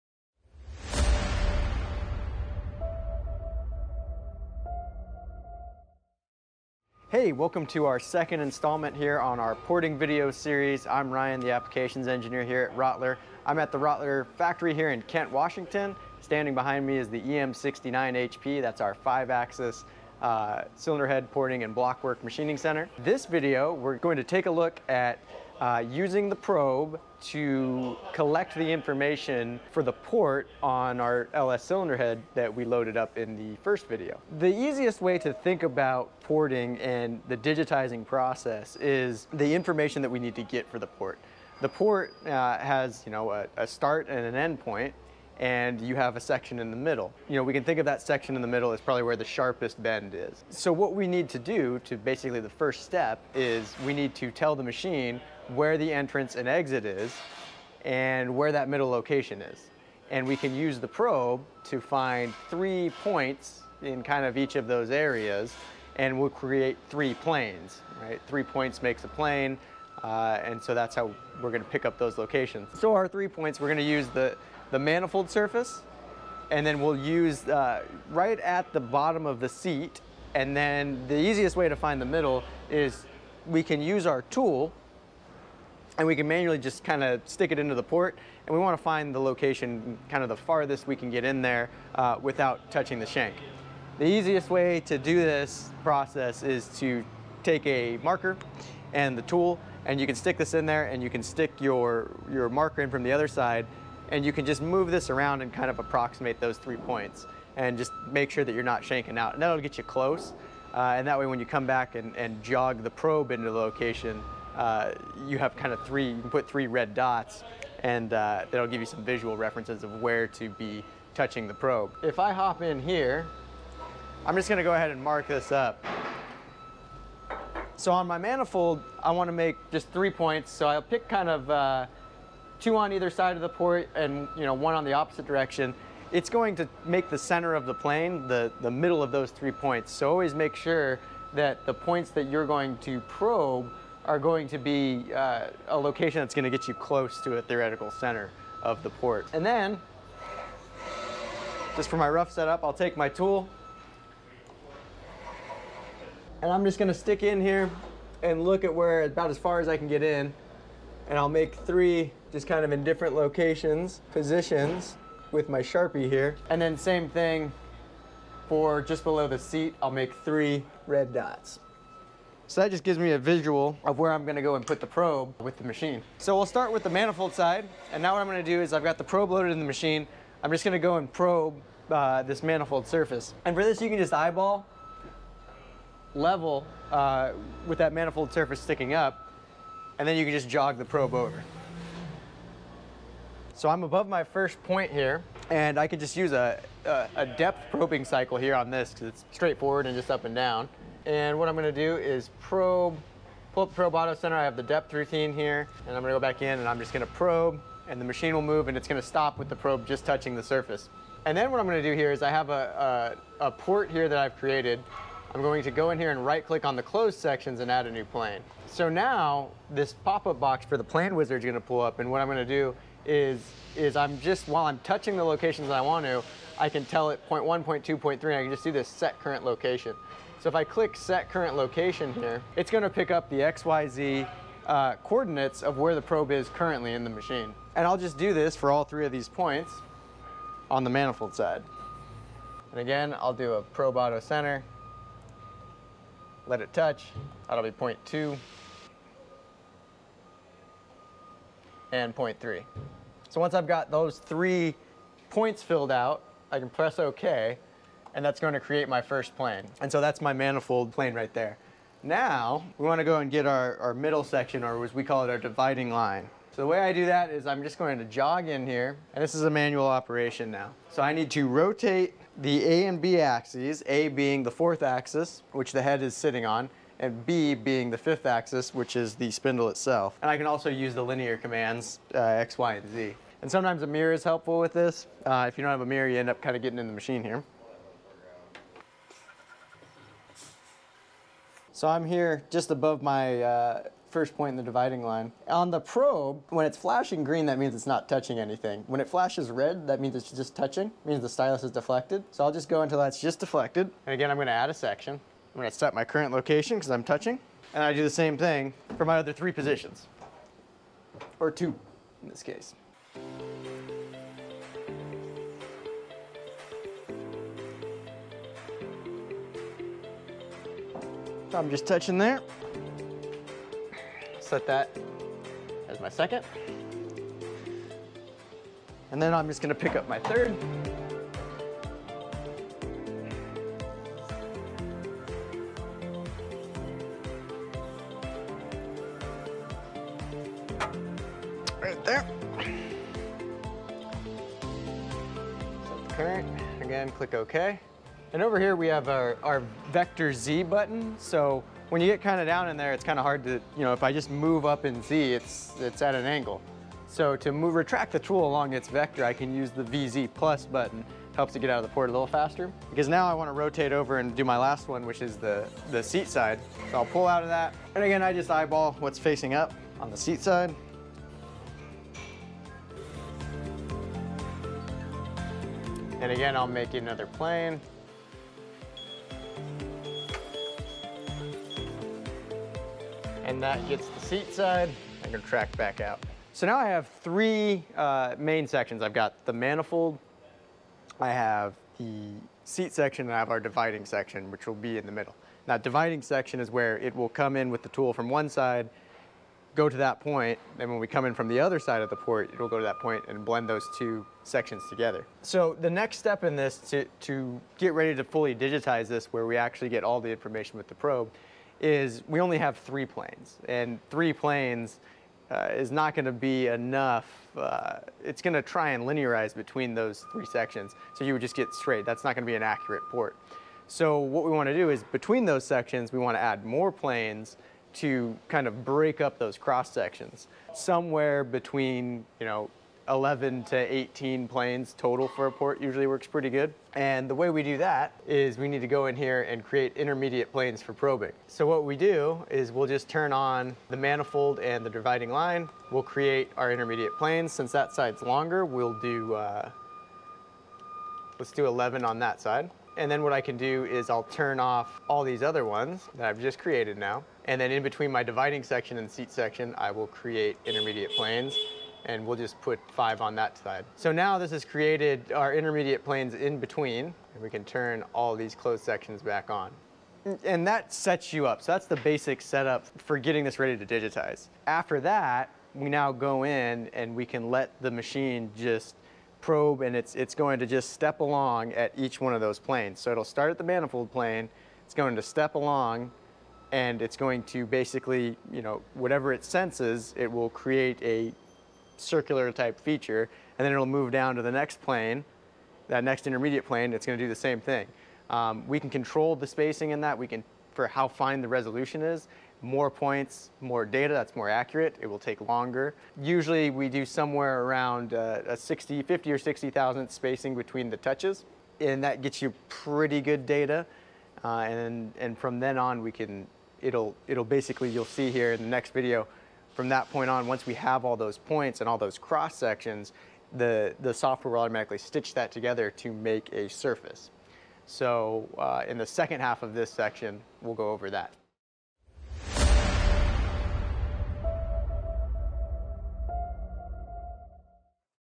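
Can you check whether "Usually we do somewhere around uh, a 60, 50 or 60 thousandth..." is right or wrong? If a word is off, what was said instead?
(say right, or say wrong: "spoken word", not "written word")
right.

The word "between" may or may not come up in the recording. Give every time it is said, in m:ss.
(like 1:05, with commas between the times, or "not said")
6:59, 7:05, 7:11, 7:37, 7:46, 8:30.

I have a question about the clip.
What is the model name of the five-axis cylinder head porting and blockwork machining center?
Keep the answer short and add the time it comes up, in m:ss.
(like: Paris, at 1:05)
EM69HP, at 0:17.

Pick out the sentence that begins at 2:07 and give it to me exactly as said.
So on my manifold, I wanna make just three points.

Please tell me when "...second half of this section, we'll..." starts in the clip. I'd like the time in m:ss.
8:49.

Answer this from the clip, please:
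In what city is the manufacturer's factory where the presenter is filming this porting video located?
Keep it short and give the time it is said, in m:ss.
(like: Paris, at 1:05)
Kent, Washington, at 0:15.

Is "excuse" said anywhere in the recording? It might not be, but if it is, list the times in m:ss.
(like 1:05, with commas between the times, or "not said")
not said.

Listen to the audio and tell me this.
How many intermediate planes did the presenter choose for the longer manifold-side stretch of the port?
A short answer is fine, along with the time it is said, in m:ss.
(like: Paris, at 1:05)
11, at 7:31.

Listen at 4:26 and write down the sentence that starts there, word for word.
So the way I do that is I'm just going to jog in here, and this is a manual operation now.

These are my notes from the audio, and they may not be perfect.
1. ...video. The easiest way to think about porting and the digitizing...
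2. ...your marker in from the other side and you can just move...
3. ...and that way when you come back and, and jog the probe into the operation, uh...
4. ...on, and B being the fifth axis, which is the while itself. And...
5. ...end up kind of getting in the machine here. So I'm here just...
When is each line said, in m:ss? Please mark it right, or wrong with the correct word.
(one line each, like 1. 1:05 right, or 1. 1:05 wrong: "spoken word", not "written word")
1. 0:33 right
2. 1:42 right
3. 1:50 wrong: "location", not "operation"
4. 4:36 wrong: "spindle", not "while"
5. 4:46 right.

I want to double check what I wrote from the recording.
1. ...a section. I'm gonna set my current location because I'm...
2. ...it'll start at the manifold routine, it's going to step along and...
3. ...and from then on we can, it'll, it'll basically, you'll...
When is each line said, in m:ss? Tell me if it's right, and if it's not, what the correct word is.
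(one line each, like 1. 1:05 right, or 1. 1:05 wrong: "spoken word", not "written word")
1. 5:04 right
2. 8:03 wrong: "plane", not "routine"
3. 8:35 right.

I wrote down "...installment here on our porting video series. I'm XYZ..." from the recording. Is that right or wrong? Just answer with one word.
wrong.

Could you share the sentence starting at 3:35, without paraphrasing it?
I'm going to go in here and right click on the closed sections and add a new plane.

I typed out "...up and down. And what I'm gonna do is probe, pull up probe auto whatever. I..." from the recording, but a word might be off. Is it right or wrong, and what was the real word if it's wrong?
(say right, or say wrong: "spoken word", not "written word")
wrong: "center", not "whatever".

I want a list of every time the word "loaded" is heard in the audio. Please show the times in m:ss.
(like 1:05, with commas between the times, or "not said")
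0:32, 2:59.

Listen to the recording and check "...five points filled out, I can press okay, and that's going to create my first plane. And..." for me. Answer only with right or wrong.
wrong.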